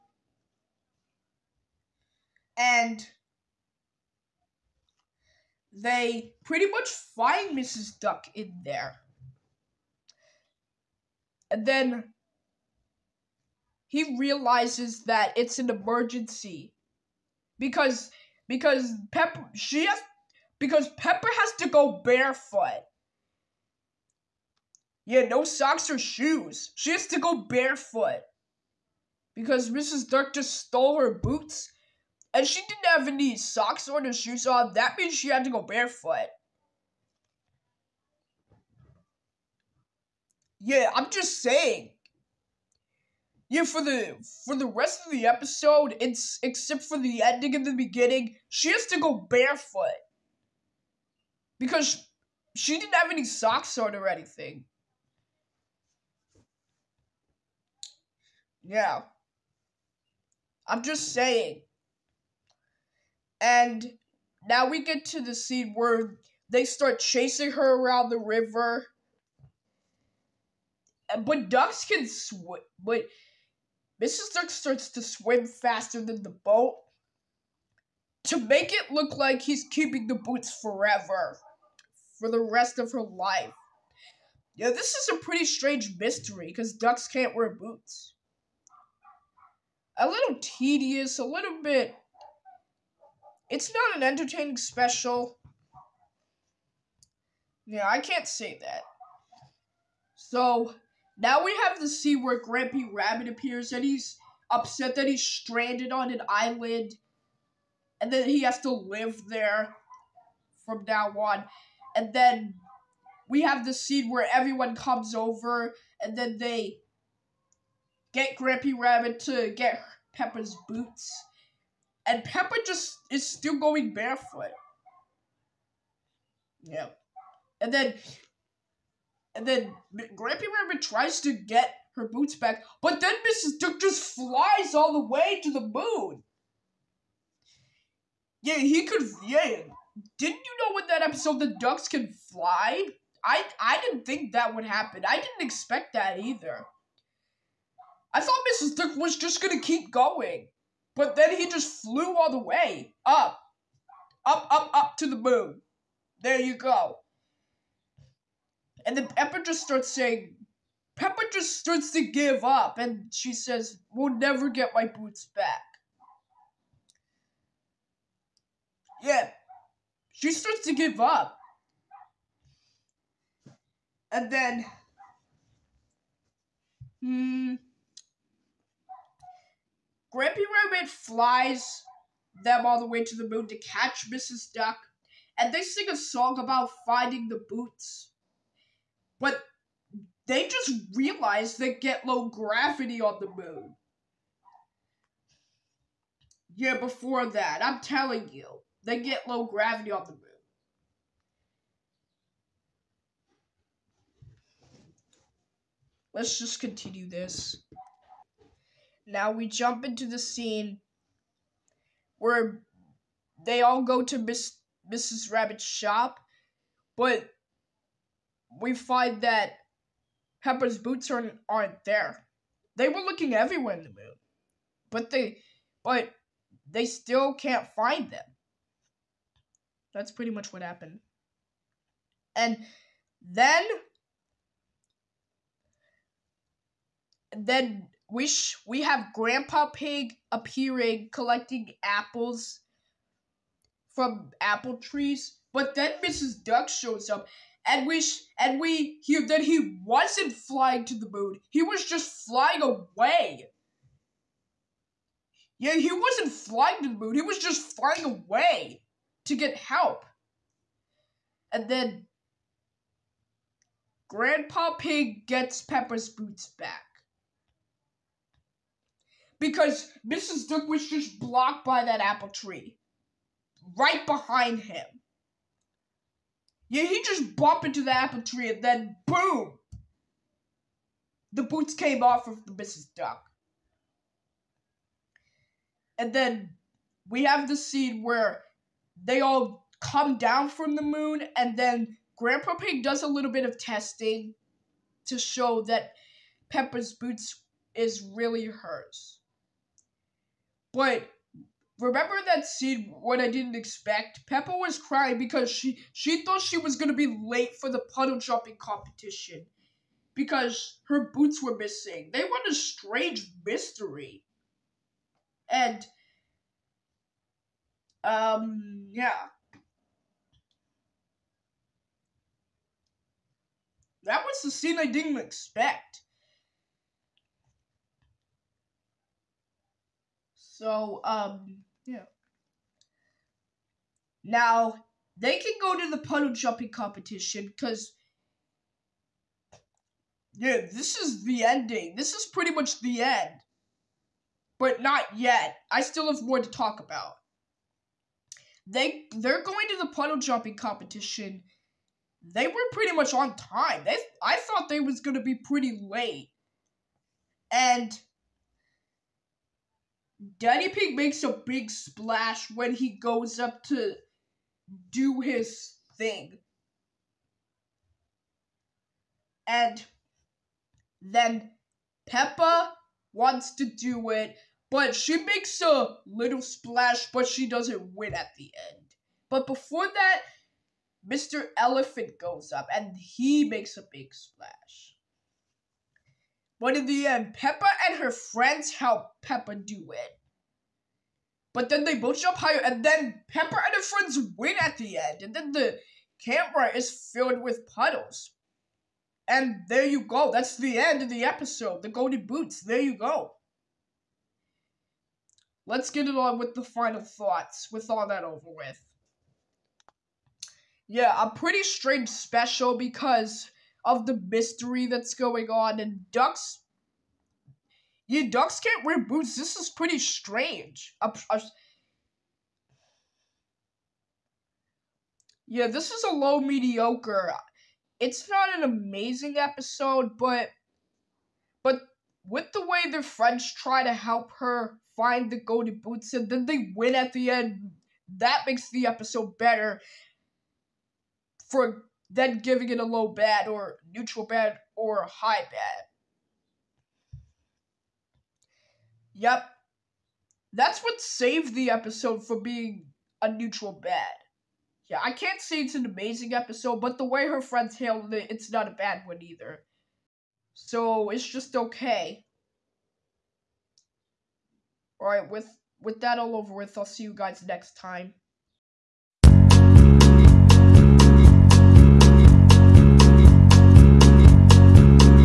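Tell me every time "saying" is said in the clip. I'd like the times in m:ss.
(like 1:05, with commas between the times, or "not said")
0:41, 1:01, 2:39.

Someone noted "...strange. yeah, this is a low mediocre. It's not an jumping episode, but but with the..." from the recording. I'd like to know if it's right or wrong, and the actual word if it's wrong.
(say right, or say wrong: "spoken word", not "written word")
wrong: "amazing", not "jumping".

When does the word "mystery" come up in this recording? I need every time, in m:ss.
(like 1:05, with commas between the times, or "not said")
1:25, 5:13, 6:54.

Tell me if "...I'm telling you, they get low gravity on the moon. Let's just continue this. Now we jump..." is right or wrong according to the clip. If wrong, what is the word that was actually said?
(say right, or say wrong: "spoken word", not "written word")
right.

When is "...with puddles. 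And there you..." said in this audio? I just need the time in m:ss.
6:37.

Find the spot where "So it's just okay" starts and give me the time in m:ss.
7:40.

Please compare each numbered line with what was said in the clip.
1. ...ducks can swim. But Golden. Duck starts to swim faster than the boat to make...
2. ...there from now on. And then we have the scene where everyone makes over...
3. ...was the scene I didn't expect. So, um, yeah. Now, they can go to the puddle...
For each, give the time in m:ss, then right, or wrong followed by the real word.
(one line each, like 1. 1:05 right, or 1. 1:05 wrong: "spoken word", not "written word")
1. 1:11 wrong: "Mrs", not "Golden"
2. 1:49 wrong: "comes", not "makes"
3. 5:24 right.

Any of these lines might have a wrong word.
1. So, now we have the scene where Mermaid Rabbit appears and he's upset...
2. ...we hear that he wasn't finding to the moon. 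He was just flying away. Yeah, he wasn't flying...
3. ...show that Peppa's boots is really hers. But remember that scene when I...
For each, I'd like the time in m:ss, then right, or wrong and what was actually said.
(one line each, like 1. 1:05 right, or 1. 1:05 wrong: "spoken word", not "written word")
1. 1:40 wrong: "Grampy", not "Mermaid"
2. 4:08 wrong: "flying", not "finding"
3. 4:55 right.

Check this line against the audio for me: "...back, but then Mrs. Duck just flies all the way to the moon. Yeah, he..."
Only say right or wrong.
right.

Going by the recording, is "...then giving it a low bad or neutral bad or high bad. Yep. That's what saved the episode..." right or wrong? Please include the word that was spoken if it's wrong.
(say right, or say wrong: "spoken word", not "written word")
right.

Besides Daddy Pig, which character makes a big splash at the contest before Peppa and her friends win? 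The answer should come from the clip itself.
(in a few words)
Mr. Elephant.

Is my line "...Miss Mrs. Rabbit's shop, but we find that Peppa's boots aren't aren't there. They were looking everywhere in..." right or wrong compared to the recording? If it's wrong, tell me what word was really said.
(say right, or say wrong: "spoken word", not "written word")
right.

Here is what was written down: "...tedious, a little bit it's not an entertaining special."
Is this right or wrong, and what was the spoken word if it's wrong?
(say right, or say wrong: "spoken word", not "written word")
right.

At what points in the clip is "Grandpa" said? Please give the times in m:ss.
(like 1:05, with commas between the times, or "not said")
3:59, 4:24, 4:52.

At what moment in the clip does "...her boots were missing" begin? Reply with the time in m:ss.
5:10.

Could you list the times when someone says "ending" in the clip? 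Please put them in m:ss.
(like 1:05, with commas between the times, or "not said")
0:47, 5:41.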